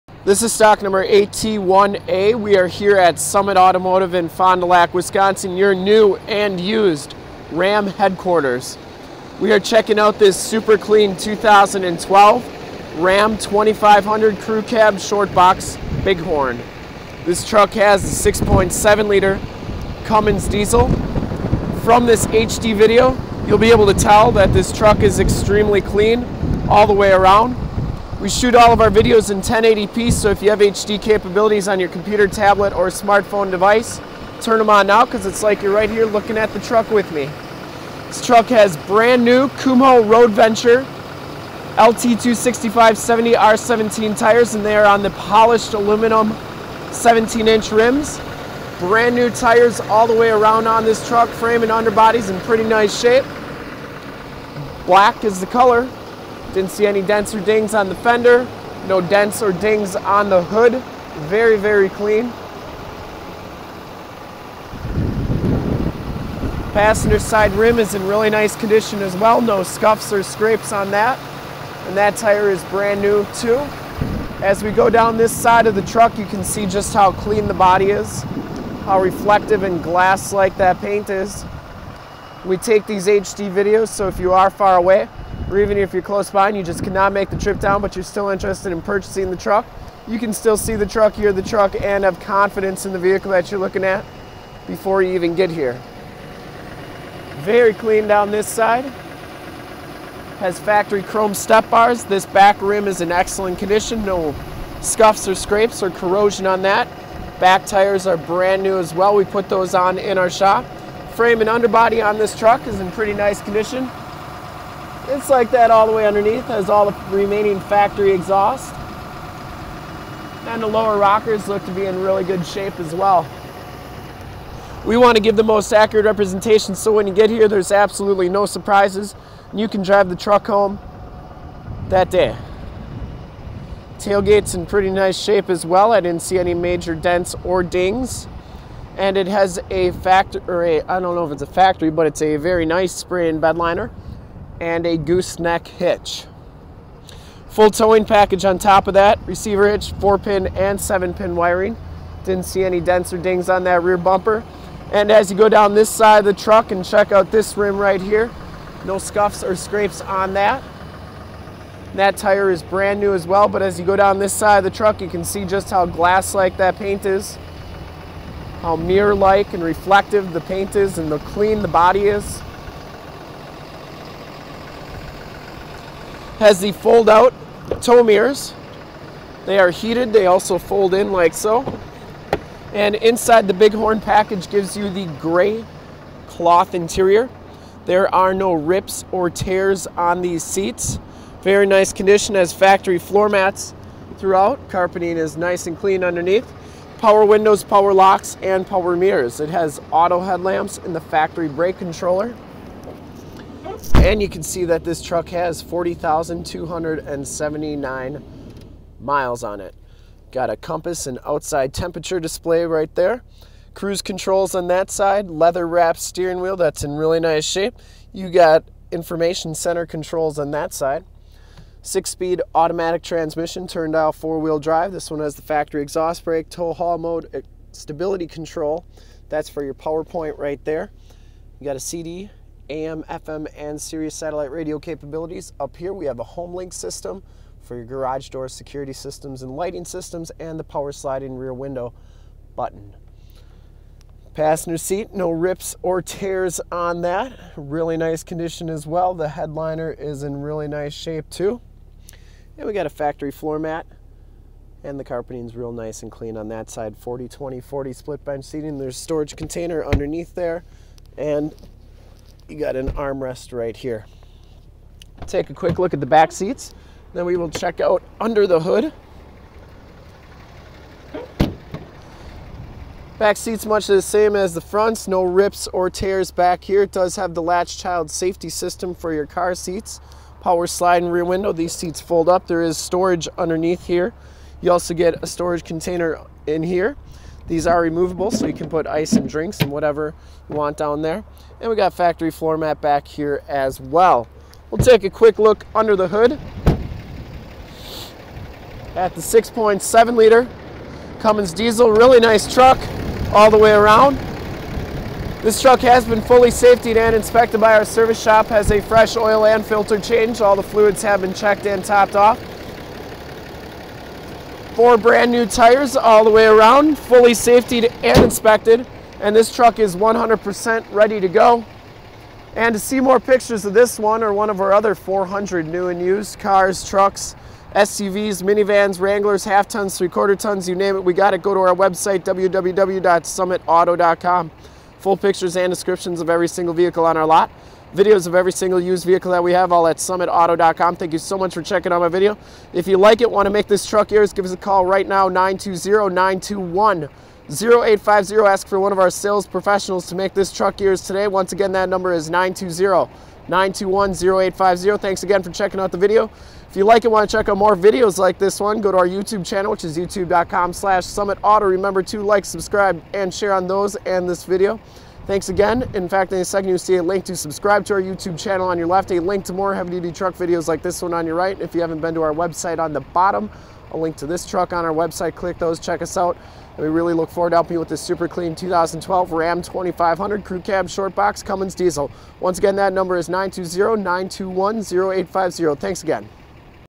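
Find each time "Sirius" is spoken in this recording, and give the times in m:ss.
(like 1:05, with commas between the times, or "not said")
3:53.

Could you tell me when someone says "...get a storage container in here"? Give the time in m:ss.
4:44.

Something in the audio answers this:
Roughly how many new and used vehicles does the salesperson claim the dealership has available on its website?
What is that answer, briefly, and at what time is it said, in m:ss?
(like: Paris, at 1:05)
400, at 5:24.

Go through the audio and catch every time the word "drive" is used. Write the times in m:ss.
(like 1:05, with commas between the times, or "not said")
2:09, 3:44.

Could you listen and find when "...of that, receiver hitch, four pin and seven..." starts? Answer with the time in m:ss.
2:28.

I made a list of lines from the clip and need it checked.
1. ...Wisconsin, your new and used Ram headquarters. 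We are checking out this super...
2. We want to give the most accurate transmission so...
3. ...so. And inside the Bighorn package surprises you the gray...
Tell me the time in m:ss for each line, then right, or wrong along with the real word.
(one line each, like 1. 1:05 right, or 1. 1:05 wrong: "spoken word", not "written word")
1. 0:04 right
2. 2:04 wrong: "representation", not "transmission"
3. 3:01 wrong: "gives", not "surprises".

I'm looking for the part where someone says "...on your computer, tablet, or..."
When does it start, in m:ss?
0:31.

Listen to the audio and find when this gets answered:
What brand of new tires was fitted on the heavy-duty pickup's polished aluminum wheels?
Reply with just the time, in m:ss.
0:39.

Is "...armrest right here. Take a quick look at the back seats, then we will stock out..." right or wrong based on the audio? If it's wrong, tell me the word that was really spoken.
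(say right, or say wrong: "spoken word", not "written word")
wrong: "check", not "stock".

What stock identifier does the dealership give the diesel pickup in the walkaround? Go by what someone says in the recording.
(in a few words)
8T1A.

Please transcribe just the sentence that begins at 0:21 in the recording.
From this HD video, you'll be able to tell that this truck is extremely clean all the way around.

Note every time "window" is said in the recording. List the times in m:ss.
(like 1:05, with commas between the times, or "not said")
3:17, 4:01, 4:41.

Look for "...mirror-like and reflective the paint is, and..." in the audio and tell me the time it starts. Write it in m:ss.
2:48.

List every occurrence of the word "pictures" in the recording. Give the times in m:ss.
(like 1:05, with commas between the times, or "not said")
5:23, 5:35.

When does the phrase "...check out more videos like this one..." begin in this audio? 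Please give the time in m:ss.
5:57.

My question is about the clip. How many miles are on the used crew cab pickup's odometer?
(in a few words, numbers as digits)
40,279.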